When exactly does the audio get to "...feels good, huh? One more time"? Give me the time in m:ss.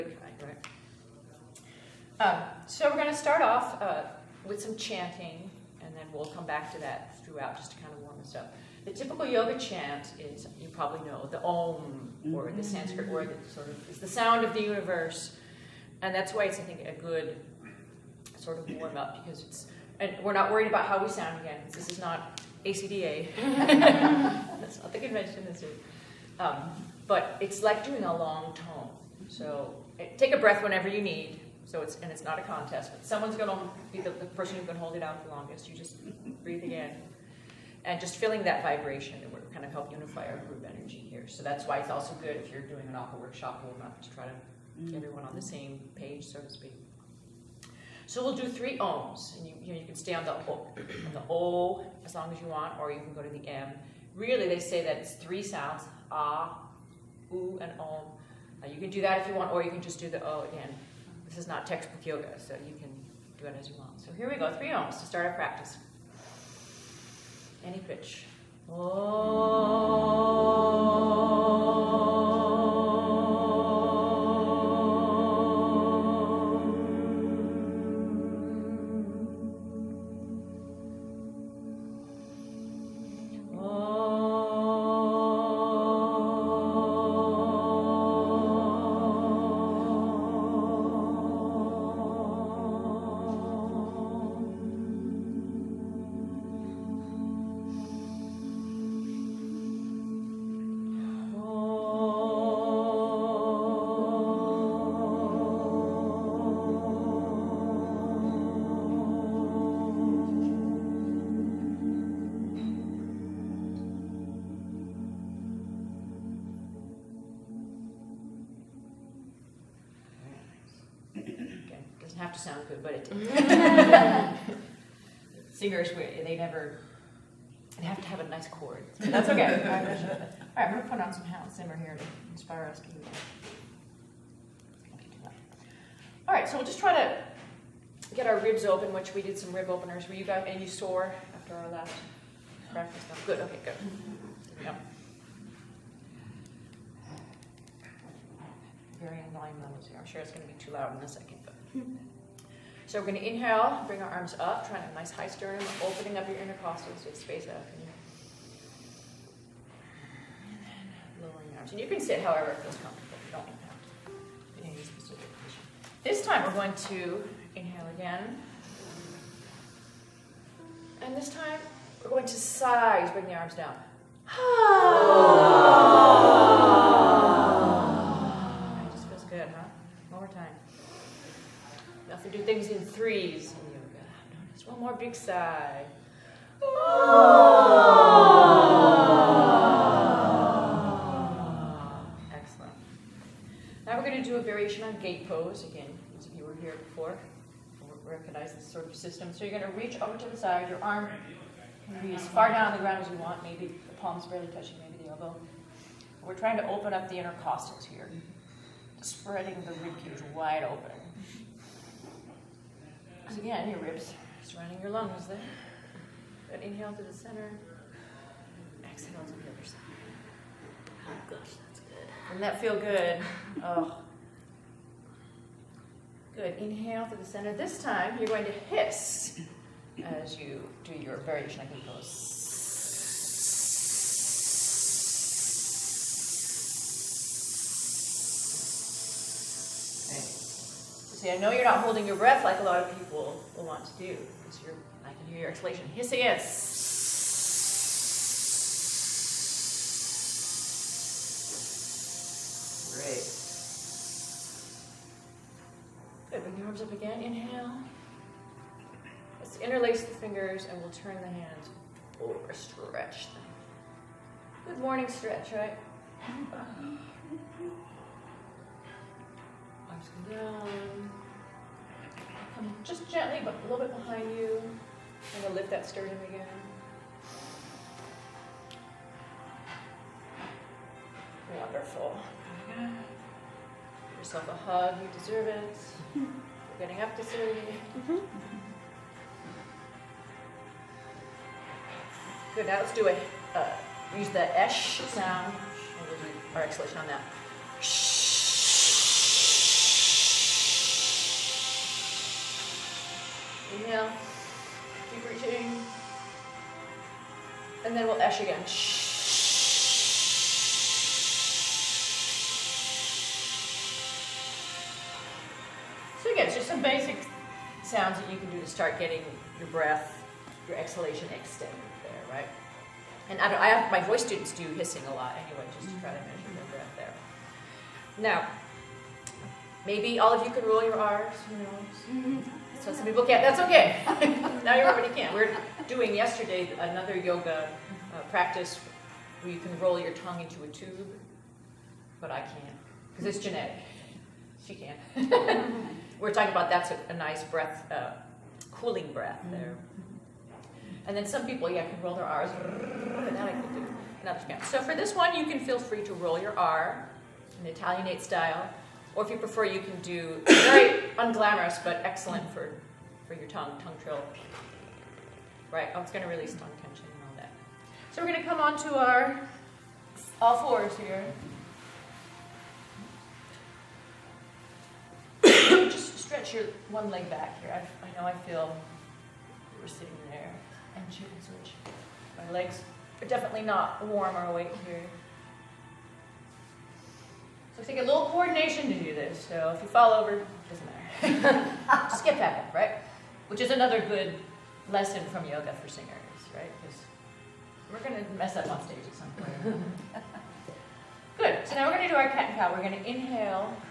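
2:59.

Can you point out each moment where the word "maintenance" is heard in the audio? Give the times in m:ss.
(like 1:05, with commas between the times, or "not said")
not said.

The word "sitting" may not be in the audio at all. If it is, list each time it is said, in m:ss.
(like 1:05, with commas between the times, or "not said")
6:19.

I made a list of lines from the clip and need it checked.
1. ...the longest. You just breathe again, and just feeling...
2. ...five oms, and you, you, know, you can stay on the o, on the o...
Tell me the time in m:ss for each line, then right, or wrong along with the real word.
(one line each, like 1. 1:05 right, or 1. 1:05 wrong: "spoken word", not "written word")
1. 0:35 right
2. 0:48 wrong: "three", not "five".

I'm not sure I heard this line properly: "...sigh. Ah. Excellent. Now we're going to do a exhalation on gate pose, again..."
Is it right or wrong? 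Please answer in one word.
wrong.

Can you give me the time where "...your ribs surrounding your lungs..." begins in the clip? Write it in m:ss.
3:33.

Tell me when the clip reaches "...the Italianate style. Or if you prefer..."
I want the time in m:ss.
5:57.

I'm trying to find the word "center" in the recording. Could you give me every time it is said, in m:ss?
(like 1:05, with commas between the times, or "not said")
3:37, 3:47.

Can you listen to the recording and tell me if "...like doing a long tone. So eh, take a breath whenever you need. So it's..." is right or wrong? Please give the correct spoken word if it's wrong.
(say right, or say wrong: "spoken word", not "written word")
right.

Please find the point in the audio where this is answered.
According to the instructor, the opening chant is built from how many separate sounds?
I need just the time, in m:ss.
0:55.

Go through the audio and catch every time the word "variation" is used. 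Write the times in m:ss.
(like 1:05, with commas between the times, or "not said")
3:14, 3:51.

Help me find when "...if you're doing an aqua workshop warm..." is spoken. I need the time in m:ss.
0:42.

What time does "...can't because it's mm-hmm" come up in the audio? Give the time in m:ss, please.
5:42.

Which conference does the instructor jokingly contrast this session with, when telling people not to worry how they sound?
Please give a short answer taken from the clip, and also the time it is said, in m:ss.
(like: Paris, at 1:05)
ACDA, at 0:22.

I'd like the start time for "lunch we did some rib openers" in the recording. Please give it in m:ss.
2:19.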